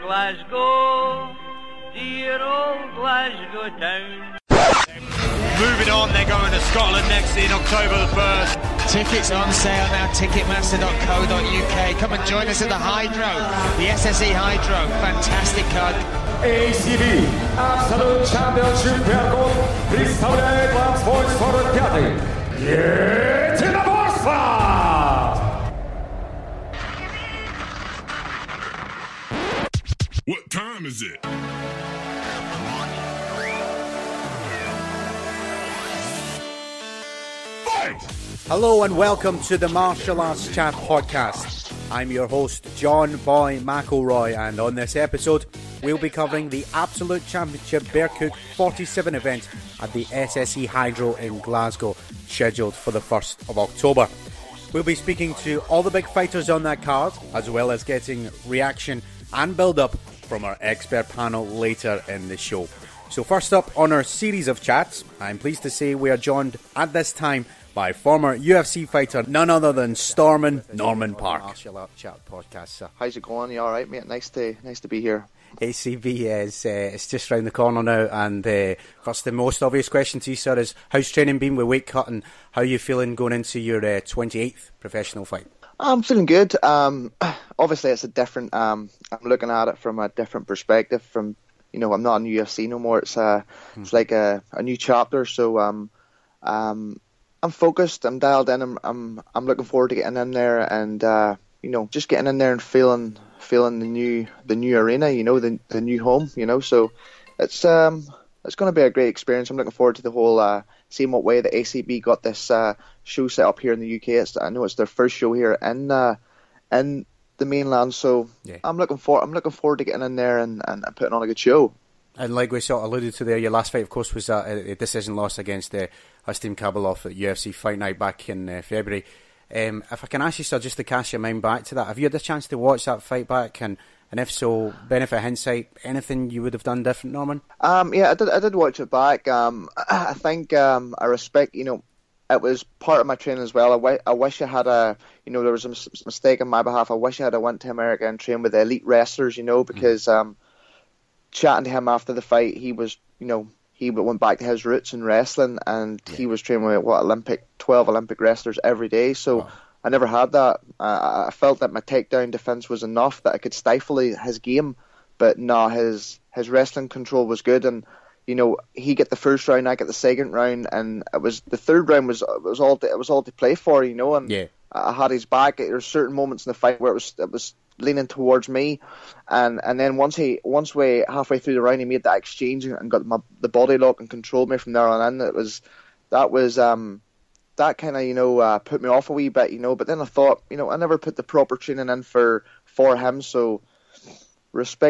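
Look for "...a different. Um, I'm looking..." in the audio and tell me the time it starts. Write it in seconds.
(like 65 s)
88 s.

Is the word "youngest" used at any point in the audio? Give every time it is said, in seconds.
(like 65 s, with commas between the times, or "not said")
not said.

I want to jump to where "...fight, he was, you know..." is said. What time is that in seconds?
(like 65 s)
152 s.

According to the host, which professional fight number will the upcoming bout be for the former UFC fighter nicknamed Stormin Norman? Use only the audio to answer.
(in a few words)
28th.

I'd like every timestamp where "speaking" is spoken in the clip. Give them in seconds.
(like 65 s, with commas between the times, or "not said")
54 s.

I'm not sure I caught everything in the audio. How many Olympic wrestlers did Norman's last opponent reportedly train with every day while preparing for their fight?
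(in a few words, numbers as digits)
12.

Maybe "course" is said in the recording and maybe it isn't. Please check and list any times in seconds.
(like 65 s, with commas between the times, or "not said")
79 s, 123 s.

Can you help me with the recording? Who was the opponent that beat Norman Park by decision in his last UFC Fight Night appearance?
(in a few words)
Astim Kabalov.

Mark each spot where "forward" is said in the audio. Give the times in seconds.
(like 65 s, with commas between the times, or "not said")
99 s, 109 s, 119 s.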